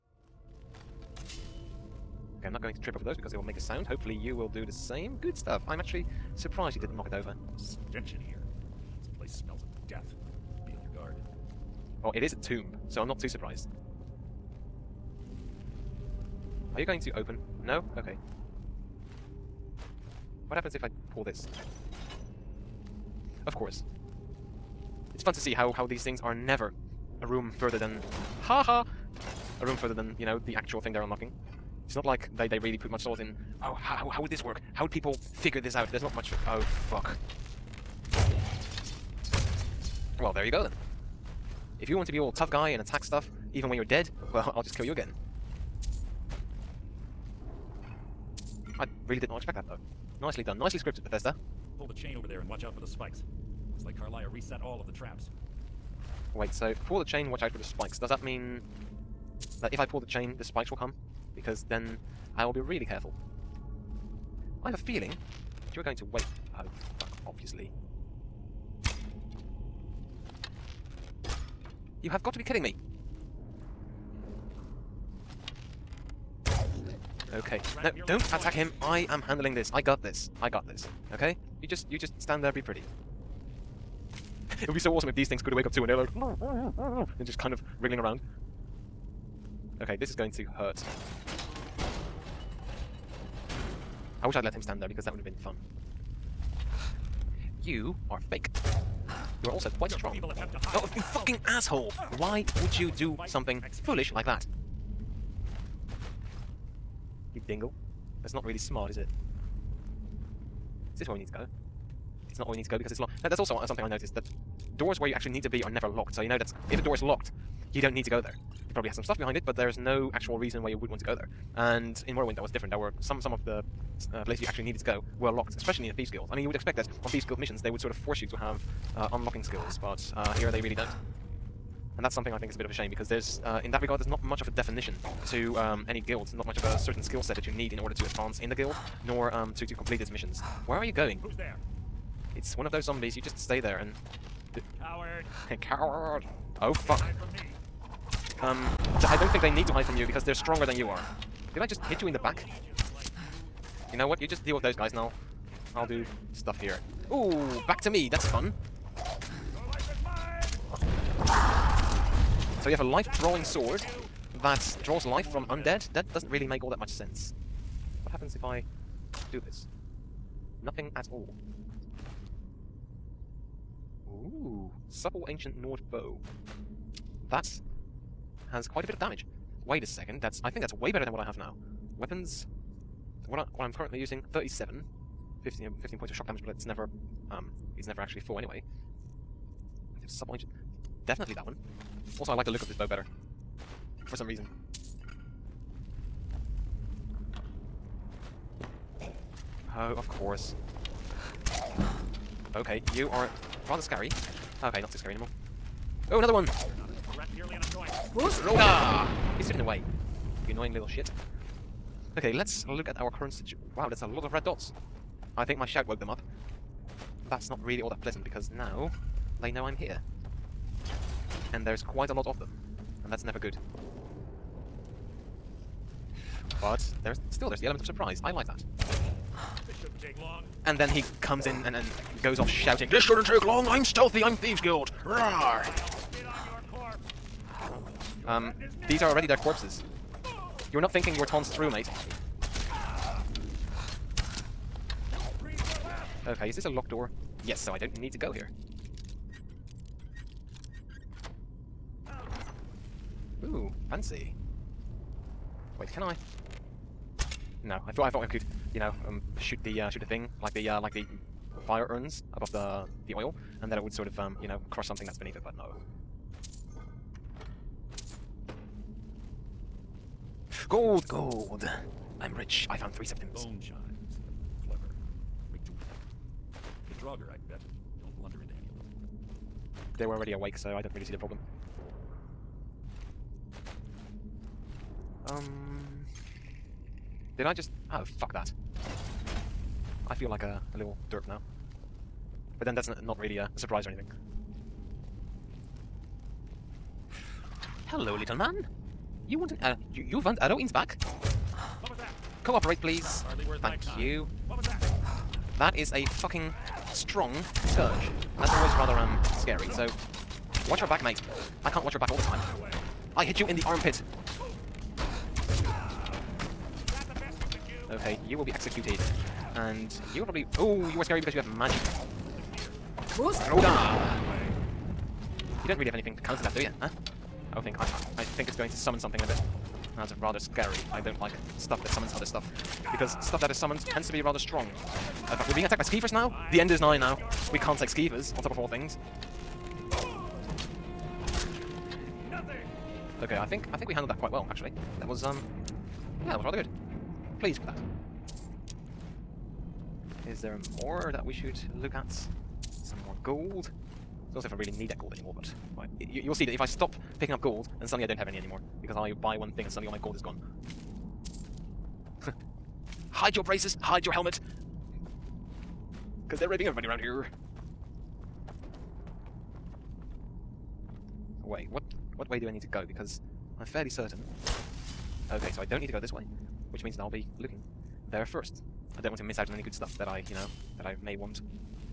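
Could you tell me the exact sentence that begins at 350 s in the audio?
Is there more that we should look at?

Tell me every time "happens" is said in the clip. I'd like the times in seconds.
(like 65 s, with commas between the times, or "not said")
20 s, 168 s.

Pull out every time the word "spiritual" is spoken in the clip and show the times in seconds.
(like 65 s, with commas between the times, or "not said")
not said.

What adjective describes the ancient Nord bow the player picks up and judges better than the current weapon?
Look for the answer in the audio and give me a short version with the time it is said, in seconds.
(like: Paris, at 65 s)
supple, at 174 s.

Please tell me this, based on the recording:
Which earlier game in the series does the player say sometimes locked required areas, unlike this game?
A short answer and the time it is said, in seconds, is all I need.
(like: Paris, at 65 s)
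Morrowind, at 122 s.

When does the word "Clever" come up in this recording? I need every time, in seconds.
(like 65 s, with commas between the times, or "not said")
274 s.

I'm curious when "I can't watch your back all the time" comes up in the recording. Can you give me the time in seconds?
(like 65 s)
311 s.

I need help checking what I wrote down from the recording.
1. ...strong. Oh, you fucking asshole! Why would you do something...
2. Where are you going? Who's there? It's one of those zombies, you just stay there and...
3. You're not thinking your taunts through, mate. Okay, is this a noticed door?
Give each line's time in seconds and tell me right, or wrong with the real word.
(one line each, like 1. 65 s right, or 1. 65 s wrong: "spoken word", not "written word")
1. 99 s right
2. 140 s right
3. 240 s wrong: "locked", not "noticed".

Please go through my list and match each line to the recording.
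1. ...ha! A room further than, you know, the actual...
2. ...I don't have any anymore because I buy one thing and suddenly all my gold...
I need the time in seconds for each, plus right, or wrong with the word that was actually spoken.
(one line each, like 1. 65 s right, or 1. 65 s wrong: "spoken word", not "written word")
1. 28 s right
2. 358 s right.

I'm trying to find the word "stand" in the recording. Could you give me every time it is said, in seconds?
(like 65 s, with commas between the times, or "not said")
82 s, 94 s.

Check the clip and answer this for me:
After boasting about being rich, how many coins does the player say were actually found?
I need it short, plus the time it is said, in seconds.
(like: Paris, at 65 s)
3 septims, at 272 s.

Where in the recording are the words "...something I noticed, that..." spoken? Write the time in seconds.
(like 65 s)
113 s.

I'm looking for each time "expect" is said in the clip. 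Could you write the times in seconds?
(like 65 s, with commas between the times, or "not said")
49 s, 126 s.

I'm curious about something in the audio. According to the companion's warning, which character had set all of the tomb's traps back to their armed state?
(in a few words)
Karliah.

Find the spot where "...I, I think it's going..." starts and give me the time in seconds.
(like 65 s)
327 s.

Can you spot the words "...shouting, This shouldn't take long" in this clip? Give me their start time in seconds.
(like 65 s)
232 s.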